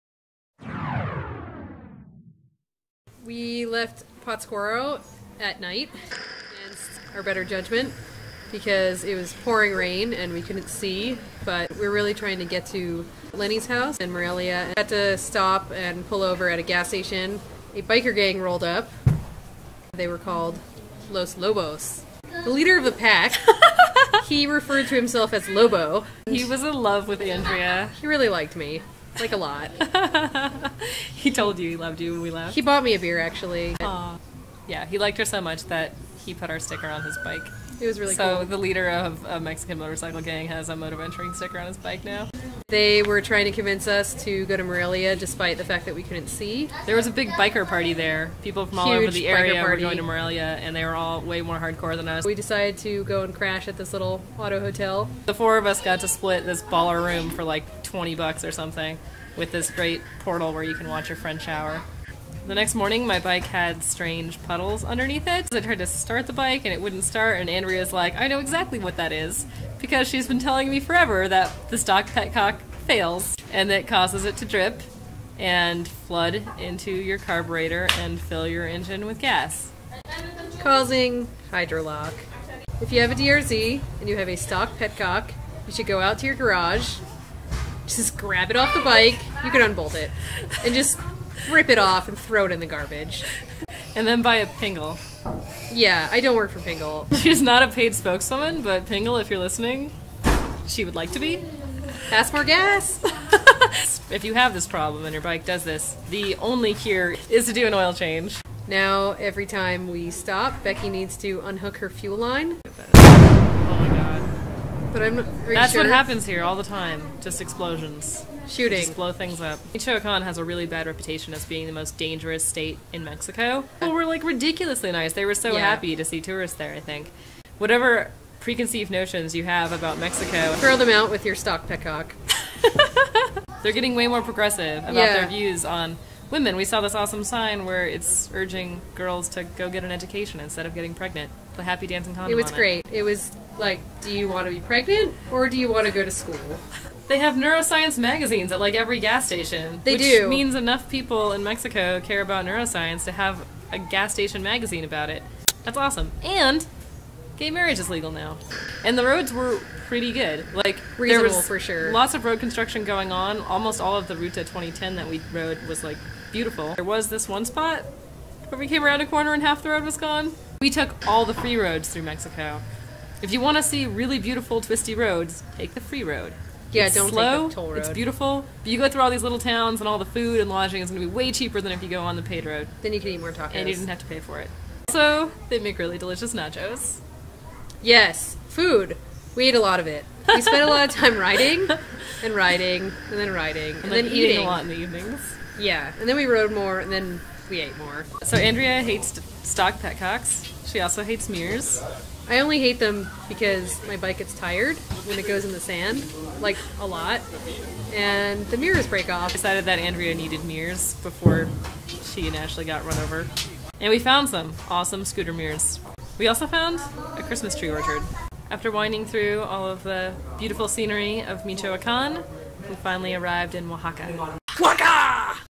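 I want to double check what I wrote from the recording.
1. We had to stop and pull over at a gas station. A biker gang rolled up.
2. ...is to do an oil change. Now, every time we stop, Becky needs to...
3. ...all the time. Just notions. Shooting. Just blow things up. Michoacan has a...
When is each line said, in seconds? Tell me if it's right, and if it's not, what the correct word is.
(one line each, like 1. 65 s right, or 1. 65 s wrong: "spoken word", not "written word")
1. 14 s right
2. 107 s right
3. 116 s wrong: "explosions", not "notions".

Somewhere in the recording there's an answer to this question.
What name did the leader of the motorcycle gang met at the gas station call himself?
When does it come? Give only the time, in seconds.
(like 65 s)
25 s.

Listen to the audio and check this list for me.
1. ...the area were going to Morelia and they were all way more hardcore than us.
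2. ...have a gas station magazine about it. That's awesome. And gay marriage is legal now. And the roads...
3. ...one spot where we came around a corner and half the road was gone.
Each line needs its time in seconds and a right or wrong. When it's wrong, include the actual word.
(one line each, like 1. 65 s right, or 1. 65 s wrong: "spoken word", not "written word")
1. 49 s right
2. 153 s right
3. 167 s right.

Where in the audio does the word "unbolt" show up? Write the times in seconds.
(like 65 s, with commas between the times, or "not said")
89 s.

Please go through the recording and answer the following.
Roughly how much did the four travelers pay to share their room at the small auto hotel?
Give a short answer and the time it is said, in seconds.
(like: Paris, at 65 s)
20 bucks, at 57 s.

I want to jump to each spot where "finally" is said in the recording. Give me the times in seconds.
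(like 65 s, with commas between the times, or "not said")
222 s.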